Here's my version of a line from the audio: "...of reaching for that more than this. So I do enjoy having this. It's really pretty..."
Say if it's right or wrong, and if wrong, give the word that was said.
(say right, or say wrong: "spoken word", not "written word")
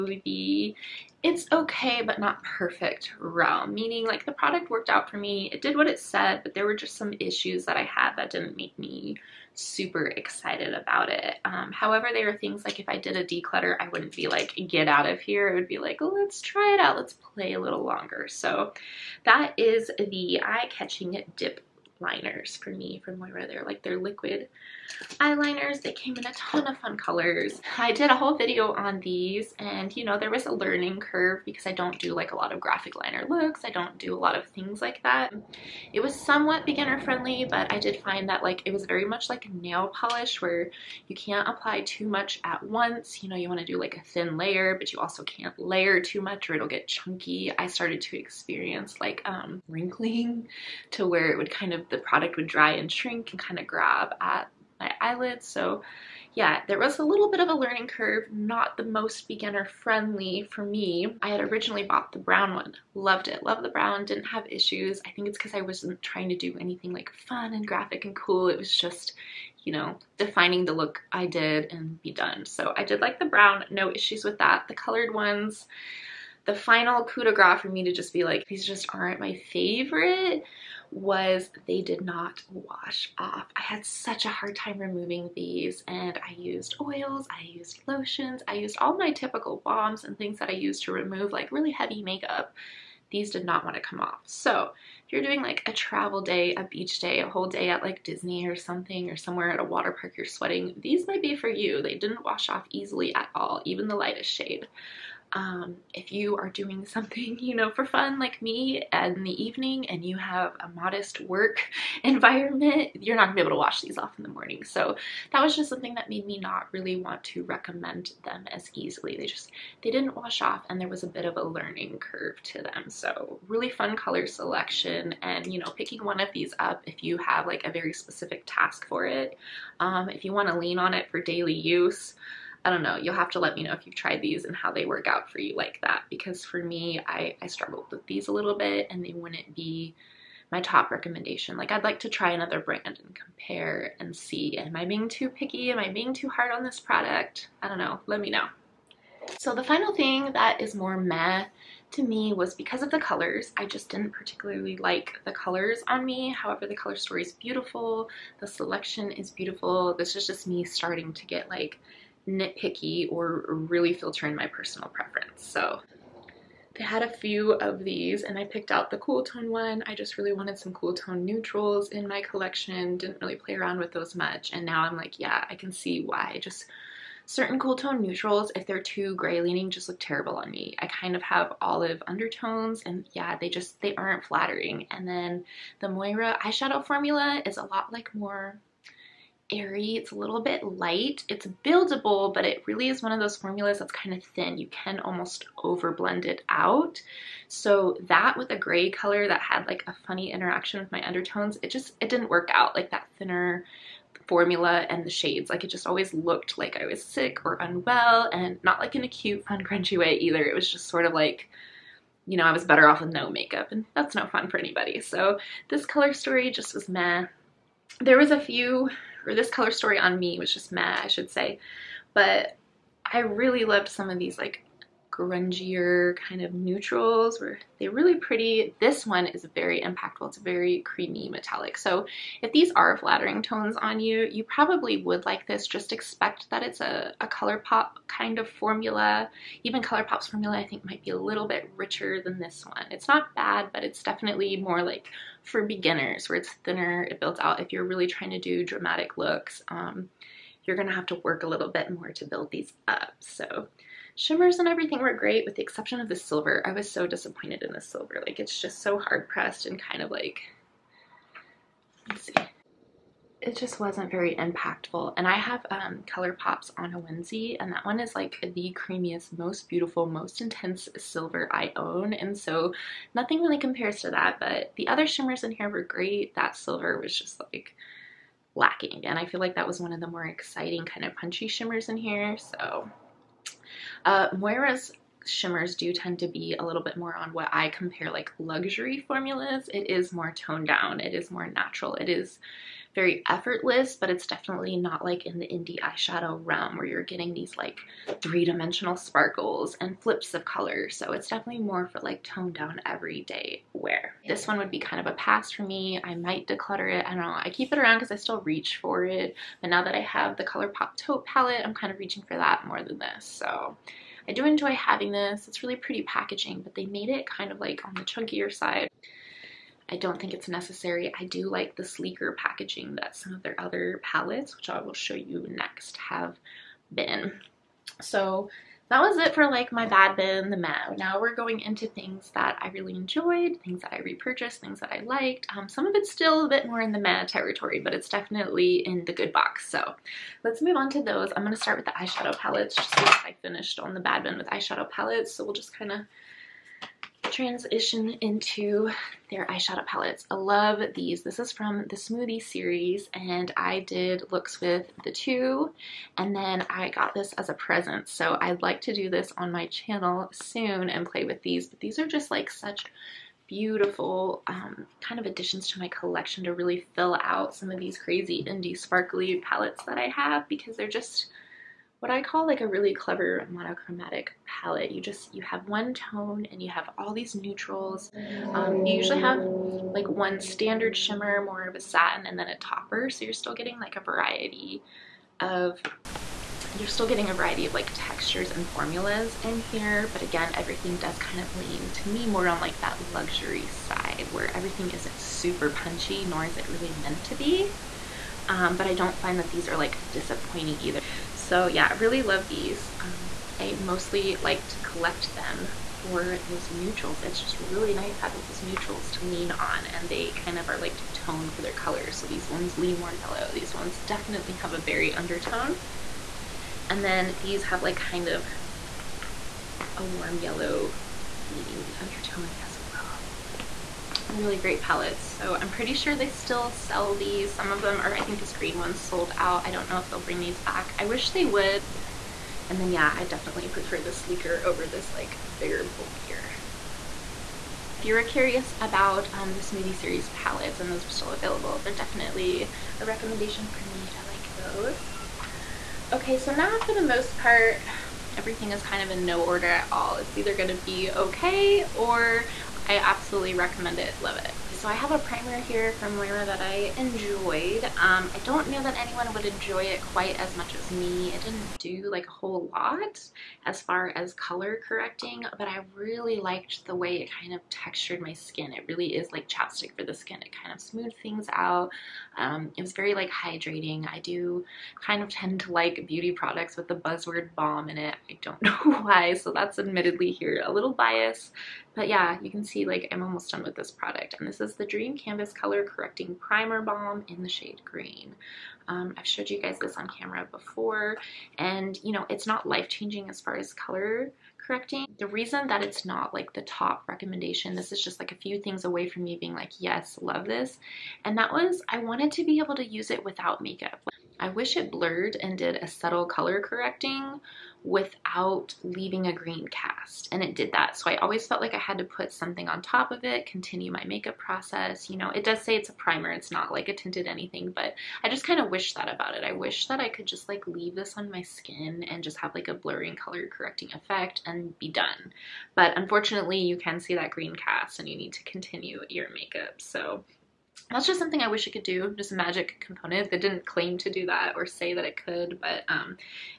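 right.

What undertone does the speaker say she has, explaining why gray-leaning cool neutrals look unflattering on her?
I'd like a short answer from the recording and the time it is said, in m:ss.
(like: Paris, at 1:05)
olive, at 3:01.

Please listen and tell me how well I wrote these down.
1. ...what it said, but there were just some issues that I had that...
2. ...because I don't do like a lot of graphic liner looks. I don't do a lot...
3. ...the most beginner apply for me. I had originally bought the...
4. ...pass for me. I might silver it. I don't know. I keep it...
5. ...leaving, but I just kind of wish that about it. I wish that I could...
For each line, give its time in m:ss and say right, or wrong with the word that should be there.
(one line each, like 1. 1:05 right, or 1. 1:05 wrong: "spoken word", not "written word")
1. 0:05 right
2. 0:31 right
3. 0:58 wrong: "friendly", not "apply"
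4. 5:05 wrong: "declutter", not "silver"
5. 8:37 wrong: "anything", not "leaving".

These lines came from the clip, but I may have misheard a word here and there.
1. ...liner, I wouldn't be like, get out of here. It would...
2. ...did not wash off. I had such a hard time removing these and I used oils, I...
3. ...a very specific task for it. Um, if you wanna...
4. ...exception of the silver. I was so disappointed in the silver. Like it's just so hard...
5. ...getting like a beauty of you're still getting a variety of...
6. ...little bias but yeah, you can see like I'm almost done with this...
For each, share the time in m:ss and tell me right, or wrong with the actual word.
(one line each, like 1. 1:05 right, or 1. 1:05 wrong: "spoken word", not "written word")
1. 0:13 wrong: "declutter", not "liner"
2. 1:21 right
3. 2:07 right
4. 4:15 right
5. 6:23 wrong: "variety", not "beauty"
6. 8:00 right.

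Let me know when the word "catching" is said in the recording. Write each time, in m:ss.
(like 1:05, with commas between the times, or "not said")
0:20.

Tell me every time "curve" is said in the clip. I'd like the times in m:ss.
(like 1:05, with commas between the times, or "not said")
0:30, 0:57, 2:01.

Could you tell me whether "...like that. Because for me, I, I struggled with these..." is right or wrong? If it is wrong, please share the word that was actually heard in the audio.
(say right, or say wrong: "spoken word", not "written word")
right.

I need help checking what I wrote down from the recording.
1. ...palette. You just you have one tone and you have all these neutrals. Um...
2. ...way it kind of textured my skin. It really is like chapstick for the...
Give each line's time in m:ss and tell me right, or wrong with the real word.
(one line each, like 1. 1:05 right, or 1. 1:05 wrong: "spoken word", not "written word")
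1. 6:14 right
2. 7:46 right.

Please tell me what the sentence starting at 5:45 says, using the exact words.
So we'll just kind of transition into their eyeshadow palettes.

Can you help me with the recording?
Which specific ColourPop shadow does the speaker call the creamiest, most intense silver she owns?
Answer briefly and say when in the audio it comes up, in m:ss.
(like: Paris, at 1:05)
On a Wednesday, at 4:26.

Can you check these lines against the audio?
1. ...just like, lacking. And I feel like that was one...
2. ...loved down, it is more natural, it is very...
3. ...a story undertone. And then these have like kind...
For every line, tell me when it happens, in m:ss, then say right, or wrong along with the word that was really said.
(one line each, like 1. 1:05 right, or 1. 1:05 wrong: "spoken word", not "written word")
1. 4:37 right
2. 4:50 wrong: "toned", not "loved"
3. 6:54 wrong: "berry", not "story".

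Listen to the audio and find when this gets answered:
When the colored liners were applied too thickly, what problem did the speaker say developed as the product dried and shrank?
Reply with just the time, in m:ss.
0:49.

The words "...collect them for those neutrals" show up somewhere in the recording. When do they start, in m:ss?
6:44.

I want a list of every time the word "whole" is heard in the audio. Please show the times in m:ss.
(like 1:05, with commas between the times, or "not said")
0:28, 1:37, 7:42.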